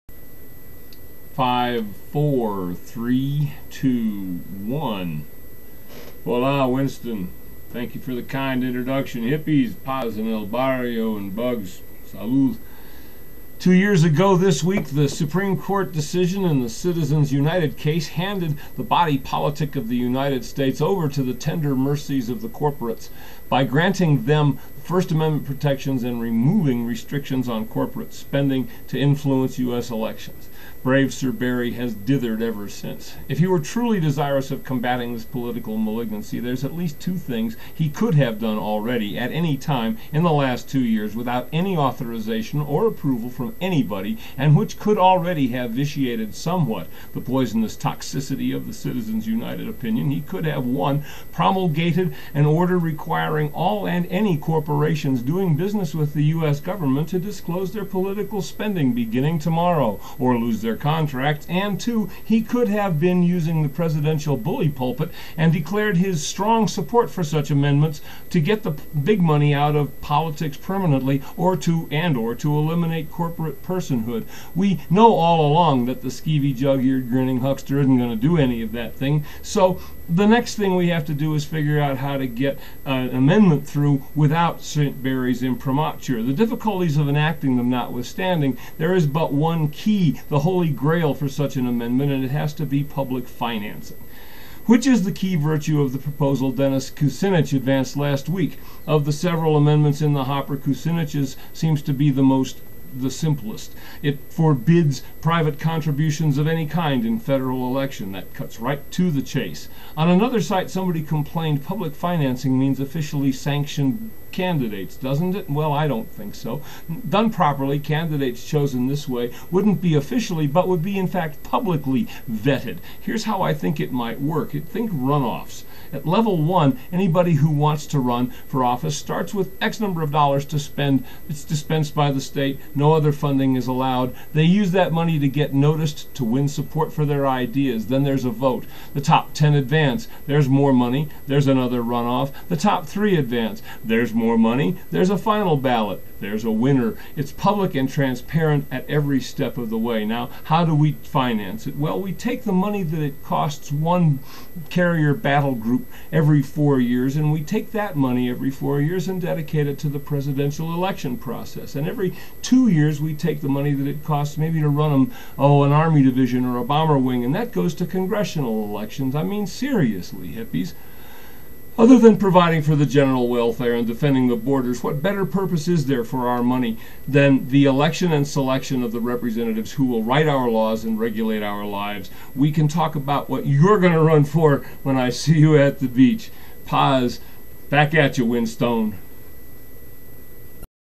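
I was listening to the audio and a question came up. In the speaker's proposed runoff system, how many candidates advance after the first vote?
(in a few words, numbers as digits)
10.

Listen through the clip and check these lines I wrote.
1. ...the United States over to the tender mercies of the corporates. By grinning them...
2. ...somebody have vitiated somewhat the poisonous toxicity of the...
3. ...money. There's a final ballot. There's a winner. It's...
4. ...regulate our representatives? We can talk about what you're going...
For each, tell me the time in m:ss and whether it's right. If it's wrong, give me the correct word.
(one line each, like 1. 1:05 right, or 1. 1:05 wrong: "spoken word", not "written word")
1. 0:19 wrong: "granting", not "grinning"
2. 0:44 wrong: "already", not "somebody"
3. 2:24 right
4. 3:00 wrong: "lives", not "representatives".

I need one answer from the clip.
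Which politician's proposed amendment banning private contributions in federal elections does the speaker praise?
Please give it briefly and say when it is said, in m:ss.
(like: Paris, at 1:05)
Dennis Kucinich, at 1:36.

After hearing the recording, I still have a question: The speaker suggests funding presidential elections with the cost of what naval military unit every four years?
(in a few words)
carrier battle group.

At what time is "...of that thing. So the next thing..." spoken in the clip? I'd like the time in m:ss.
1:18.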